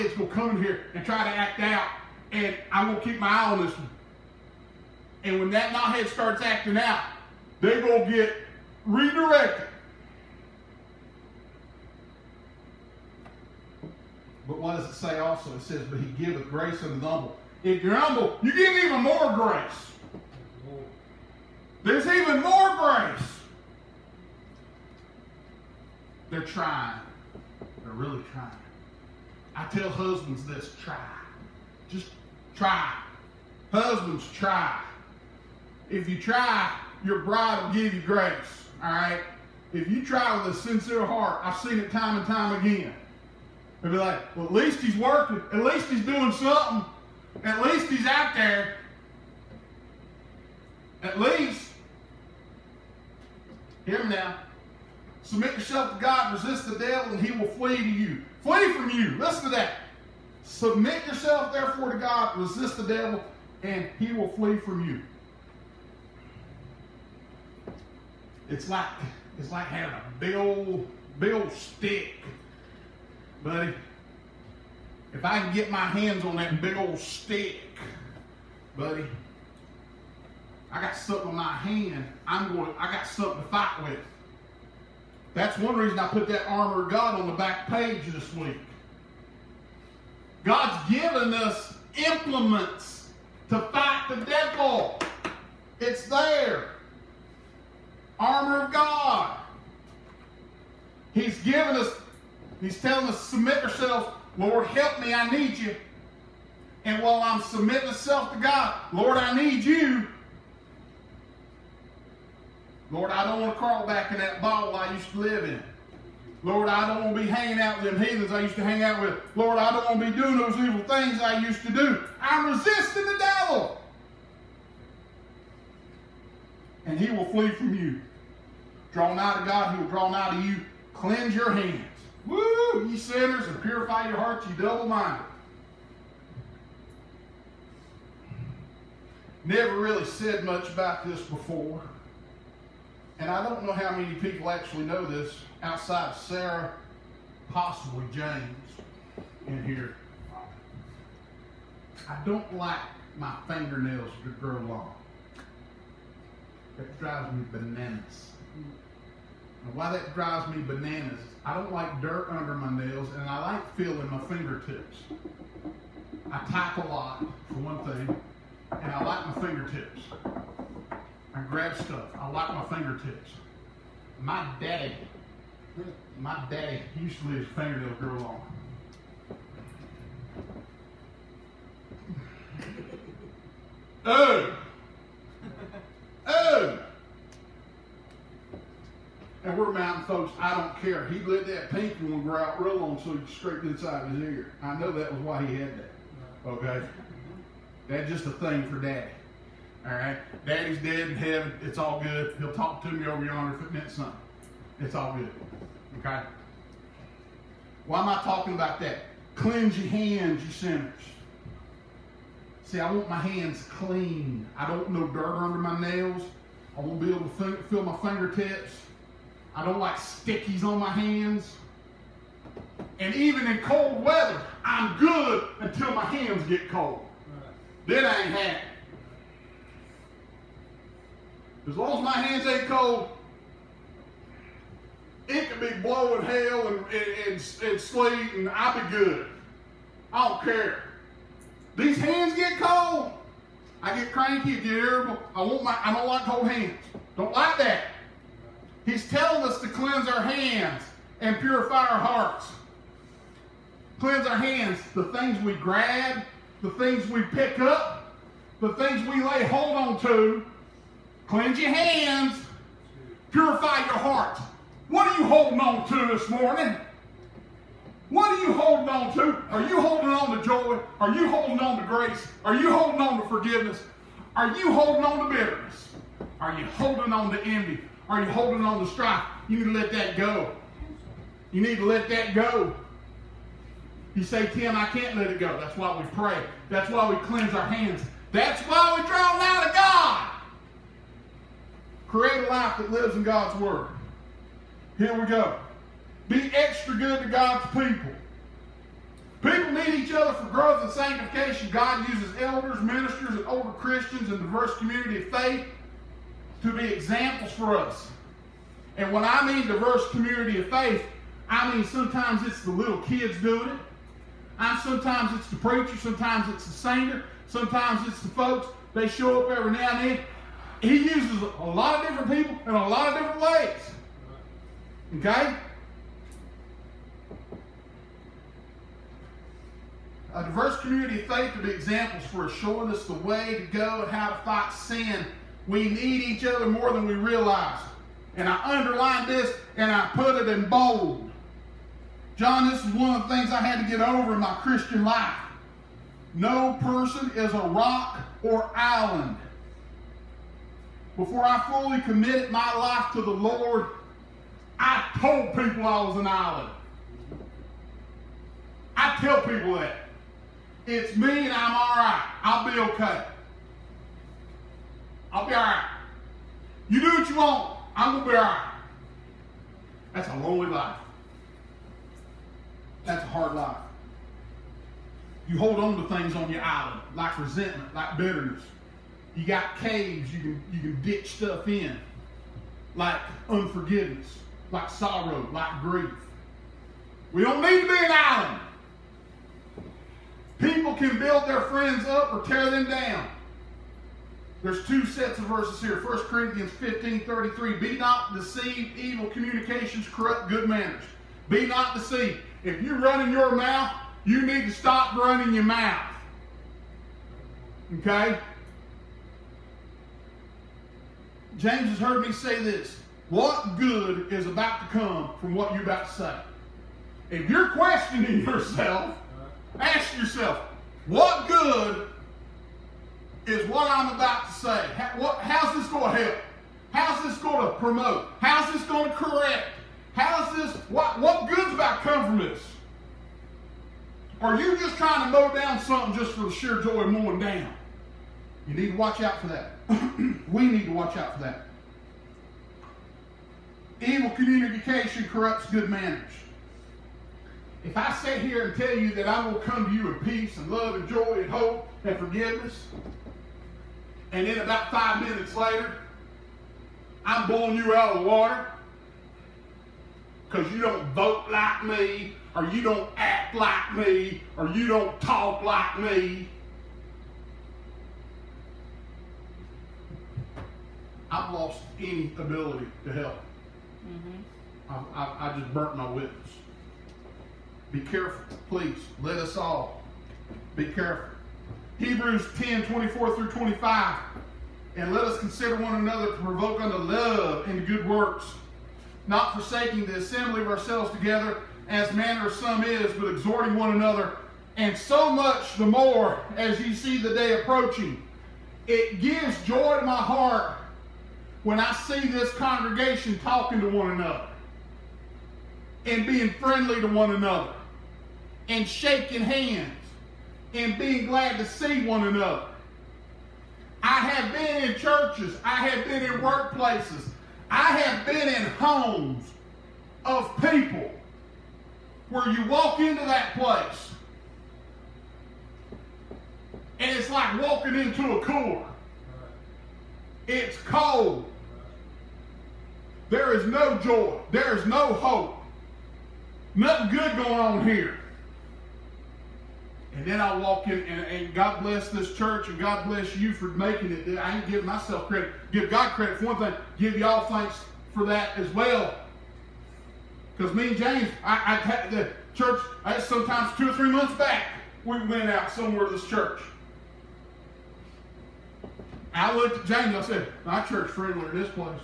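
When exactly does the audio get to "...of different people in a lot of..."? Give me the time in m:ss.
5:22.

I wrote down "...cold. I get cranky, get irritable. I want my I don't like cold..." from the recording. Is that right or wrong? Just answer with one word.
right.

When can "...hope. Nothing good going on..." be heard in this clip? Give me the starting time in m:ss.
8:55.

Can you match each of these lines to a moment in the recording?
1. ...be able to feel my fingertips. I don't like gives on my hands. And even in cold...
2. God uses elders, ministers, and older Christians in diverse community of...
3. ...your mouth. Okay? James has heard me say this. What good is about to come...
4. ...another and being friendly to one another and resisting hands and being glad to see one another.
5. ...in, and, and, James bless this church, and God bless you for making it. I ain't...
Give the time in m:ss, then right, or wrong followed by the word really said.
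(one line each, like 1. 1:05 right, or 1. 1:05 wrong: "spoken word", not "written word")
1. 3:36 wrong: "stickies", not "gives"
2. 5:01 right
3. 6:45 right
4. 8:24 wrong: "shaking", not "resisting"
5. 9:00 wrong: "God", not "James".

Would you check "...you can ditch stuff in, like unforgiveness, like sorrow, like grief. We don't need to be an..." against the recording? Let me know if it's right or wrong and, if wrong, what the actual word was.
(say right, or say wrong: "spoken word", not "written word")
right.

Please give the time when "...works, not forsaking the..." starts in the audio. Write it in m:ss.
8:08.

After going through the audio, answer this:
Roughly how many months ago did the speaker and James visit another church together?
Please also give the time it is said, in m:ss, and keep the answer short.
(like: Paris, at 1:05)
2 or 3 months, at 9:13.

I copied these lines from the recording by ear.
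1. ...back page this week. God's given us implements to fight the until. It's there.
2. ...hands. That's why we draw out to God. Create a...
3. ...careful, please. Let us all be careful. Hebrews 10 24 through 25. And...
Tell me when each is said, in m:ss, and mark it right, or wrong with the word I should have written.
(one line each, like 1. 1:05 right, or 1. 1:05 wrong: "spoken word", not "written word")
1. 1:27 wrong: "devil", not "until"
2. 4:47 right
3. 7:57 right.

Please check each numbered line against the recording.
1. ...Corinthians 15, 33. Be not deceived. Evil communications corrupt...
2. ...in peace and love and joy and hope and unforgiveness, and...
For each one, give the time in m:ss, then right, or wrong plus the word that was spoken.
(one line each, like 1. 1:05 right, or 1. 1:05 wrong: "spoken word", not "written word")
1. 6:36 right
2. 7:30 wrong: "forgiveness", not "unforgiveness".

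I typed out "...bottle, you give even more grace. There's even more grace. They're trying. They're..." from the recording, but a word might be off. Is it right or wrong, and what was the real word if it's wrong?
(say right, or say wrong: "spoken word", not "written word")
wrong: "humble", not "bottle".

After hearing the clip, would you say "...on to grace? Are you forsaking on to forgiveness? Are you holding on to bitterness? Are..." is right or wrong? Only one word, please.
wrong.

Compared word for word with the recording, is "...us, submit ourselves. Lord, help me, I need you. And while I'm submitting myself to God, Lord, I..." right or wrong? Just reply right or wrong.
right.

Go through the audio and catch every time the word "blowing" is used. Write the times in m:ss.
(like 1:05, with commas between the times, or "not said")
3:55, 7:37.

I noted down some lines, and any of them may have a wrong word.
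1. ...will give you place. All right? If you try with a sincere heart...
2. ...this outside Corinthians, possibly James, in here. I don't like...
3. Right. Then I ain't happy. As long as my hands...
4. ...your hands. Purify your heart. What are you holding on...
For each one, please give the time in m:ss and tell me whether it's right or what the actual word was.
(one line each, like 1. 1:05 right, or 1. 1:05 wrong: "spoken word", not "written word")
1. 0:37 wrong: "grace", not "place"
2. 2:25 wrong: "Sarah", not "Corinthians"
3. 3:47 right
4. 4:21 right.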